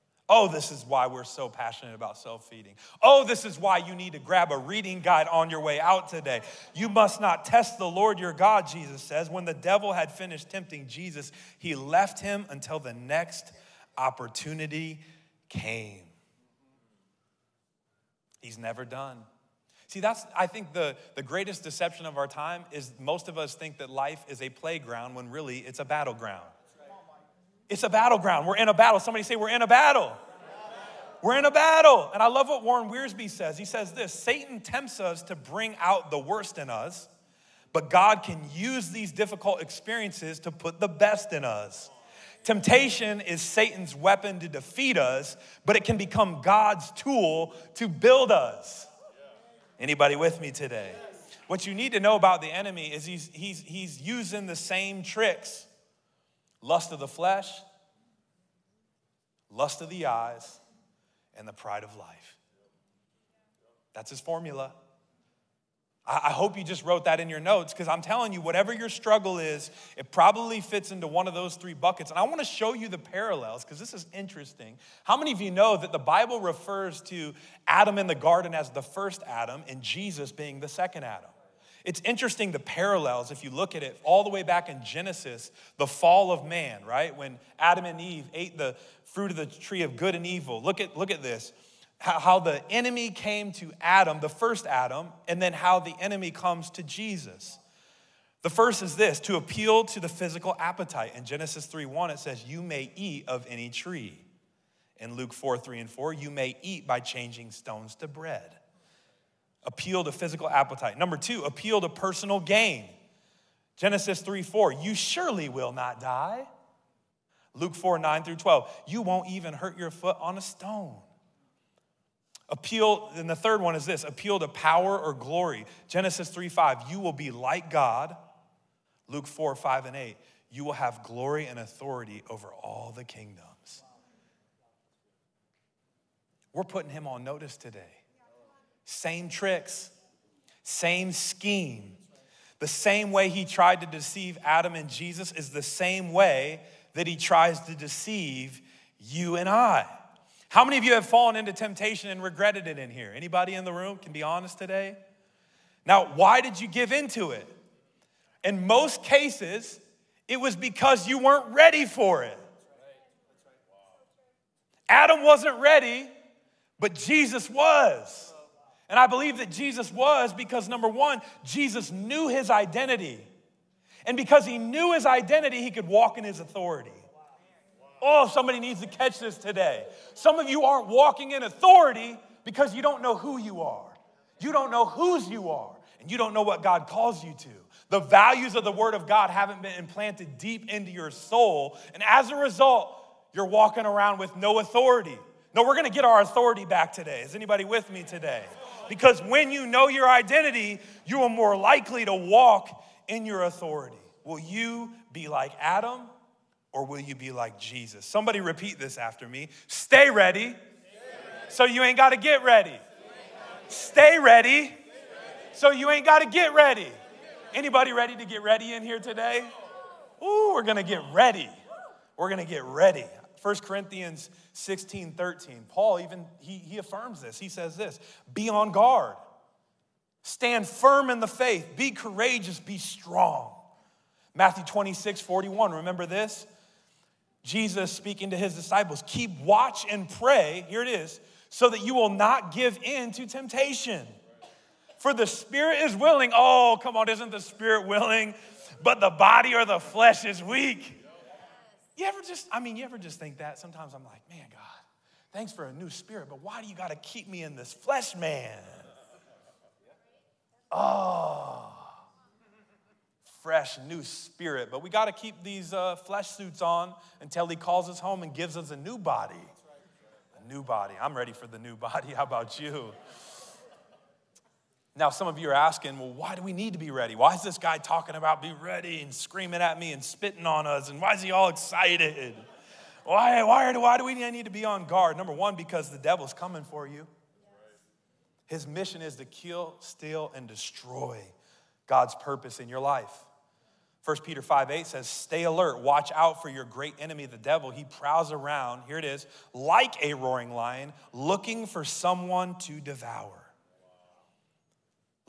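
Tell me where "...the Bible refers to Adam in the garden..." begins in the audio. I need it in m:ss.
1:15.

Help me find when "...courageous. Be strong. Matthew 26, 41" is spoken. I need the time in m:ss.
3:51.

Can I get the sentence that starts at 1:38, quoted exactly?
The first is this to appeal to the physical appetite.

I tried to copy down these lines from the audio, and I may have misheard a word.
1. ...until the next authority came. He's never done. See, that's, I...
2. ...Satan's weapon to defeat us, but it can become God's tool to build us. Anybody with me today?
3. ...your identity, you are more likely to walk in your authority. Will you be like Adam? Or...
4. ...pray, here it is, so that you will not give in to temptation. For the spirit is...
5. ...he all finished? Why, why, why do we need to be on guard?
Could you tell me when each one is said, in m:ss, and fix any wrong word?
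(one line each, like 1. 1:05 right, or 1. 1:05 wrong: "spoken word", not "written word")
1. 0:12 wrong: "opportunity", not "authority"
2. 0:43 right
3. 3:19 right
4. 4:00 right
5. 4:41 wrong: "excited", not "finished".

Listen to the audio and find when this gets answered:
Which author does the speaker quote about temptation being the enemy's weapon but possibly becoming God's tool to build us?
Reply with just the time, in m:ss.
0:32.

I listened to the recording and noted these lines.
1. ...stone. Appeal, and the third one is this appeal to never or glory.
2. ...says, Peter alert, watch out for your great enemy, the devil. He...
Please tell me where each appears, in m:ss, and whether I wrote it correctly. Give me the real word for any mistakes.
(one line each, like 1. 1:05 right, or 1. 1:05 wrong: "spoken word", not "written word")
1. 2:00 wrong: "power", not "never"
2. 4:54 wrong: "Stay", not "Peter".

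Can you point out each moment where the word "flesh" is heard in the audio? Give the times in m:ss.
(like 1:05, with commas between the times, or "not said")
0:57, 4:09, 4:17, 4:25.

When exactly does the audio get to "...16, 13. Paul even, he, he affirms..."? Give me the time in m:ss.
3:44.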